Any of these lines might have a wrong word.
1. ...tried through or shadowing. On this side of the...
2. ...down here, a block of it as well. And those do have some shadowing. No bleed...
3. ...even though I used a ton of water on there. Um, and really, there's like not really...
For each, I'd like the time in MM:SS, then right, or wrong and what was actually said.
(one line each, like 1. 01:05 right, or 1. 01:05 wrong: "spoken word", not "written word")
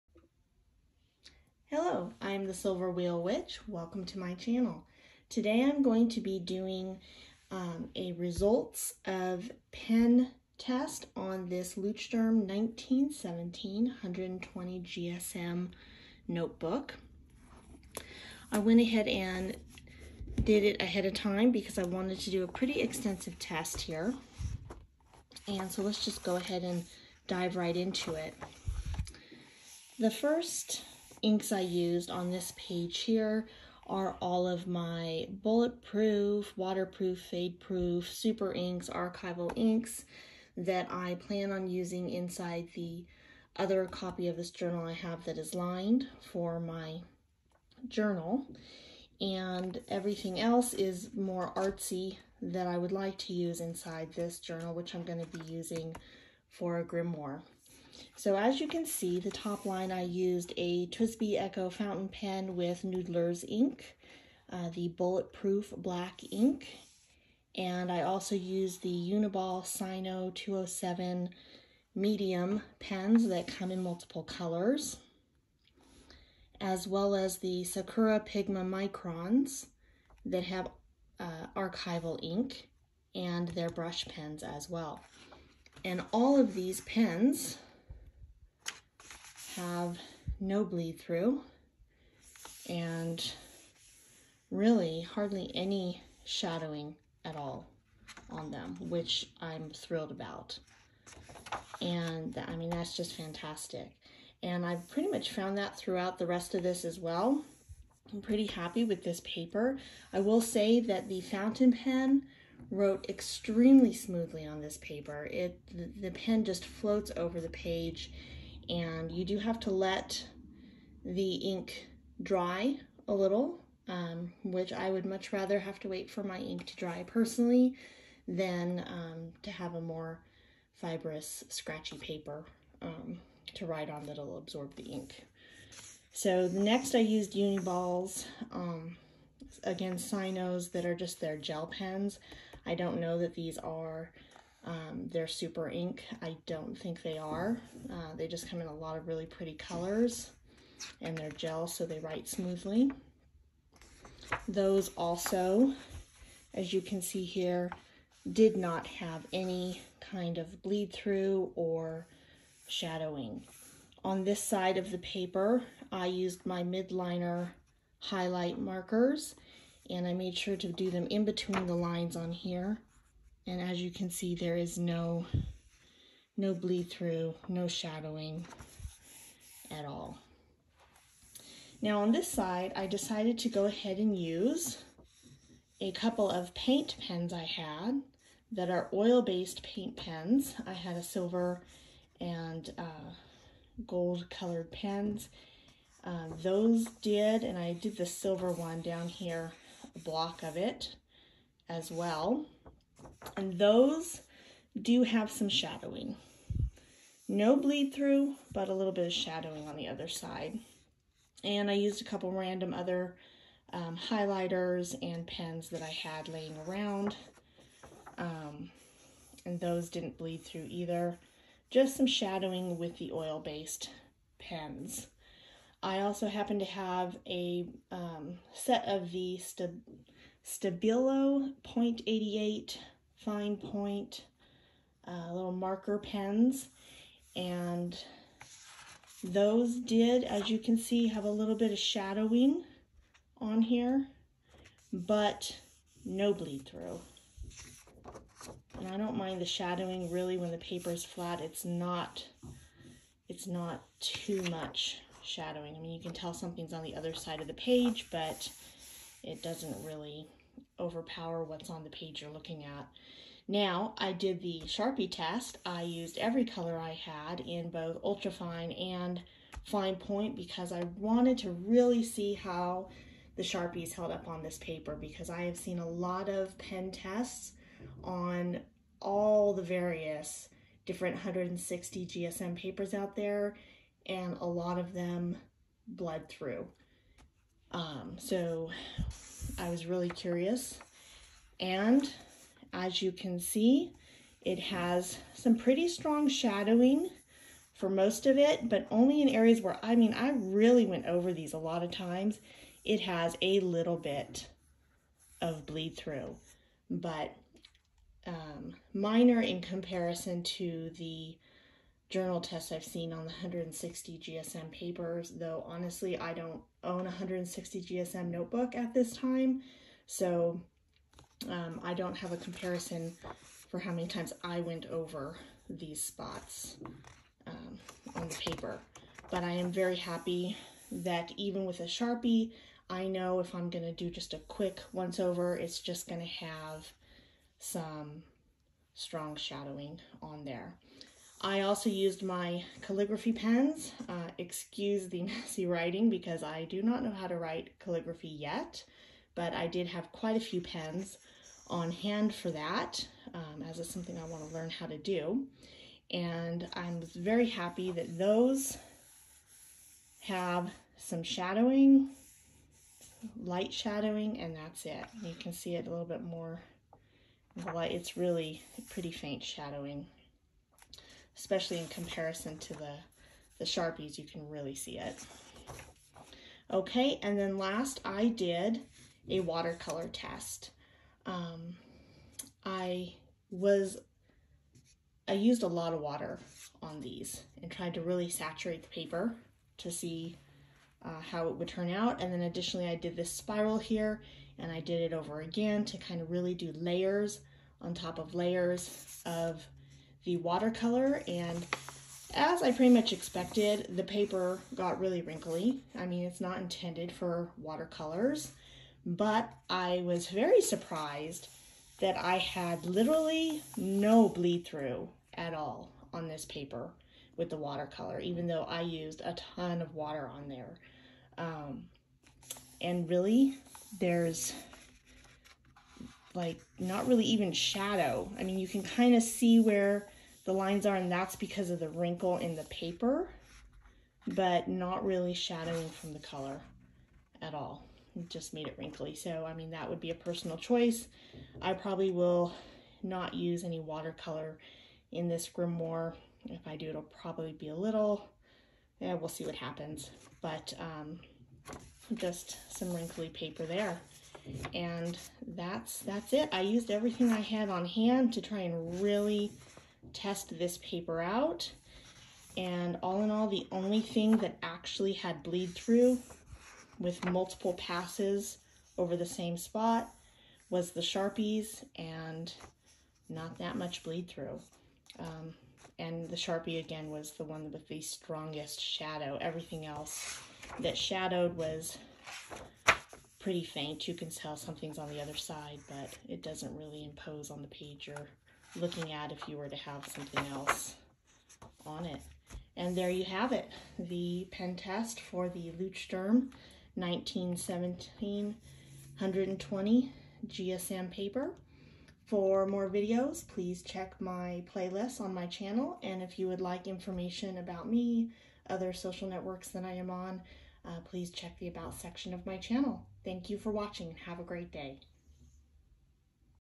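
1. 02:40 wrong: "bleed", not "tried"
2. 03:18 right
3. 06:58 right.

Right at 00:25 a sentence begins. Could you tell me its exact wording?
And so let's just go ahead and dive right into it.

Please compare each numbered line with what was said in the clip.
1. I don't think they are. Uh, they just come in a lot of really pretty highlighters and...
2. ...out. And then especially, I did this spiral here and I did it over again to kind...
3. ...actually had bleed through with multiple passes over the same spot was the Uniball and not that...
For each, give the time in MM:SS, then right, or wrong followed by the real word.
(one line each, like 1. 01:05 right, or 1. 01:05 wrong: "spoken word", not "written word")
1. 02:26 wrong: "colors", not "highlighters"
2. 06:31 wrong: "additionally", not "especially"
3. 07:44 wrong: "Sharpies", not "Uniball".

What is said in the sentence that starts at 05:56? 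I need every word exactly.
And I'm very happy that those have some shadowing, light shadowing, and that's it.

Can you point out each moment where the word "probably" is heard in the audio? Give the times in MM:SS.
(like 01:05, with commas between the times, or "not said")
07:21, 07:27.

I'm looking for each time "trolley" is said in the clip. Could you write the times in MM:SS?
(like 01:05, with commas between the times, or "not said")
not said.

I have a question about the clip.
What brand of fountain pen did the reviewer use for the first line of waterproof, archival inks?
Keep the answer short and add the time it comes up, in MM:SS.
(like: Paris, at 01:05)
TWSBI Eco, at 01:00.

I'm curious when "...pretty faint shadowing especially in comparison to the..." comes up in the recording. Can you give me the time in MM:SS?
06:08.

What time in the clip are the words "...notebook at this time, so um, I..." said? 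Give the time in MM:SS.
05:18.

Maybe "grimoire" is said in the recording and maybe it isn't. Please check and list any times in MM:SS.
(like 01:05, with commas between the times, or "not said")
00:56, 07:25.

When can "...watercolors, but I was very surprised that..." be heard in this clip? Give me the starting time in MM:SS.
06:47.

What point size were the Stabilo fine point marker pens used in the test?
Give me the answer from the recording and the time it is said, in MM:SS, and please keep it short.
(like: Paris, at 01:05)
0.88, at 03:51.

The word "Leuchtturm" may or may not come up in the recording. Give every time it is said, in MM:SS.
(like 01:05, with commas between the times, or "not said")
00:11, 08:15.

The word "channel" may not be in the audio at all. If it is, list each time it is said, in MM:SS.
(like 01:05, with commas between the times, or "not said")
00:04, 08:25, 08:32.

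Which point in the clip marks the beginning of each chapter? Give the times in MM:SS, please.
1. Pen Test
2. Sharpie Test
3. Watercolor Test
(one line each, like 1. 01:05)
1. 00:29
2. 04:23
3. 06:17.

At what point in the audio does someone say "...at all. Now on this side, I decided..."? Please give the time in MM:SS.
02:59.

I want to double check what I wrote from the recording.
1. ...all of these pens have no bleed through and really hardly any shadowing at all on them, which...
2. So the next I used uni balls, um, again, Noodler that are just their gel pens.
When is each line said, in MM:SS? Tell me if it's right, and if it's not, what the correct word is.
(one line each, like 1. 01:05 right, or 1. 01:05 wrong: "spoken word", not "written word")
1. 01:26 right
2. 02:16 wrong: "Signos", not "Noodler".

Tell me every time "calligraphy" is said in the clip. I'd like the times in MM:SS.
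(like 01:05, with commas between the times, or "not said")
05:42, 05:47.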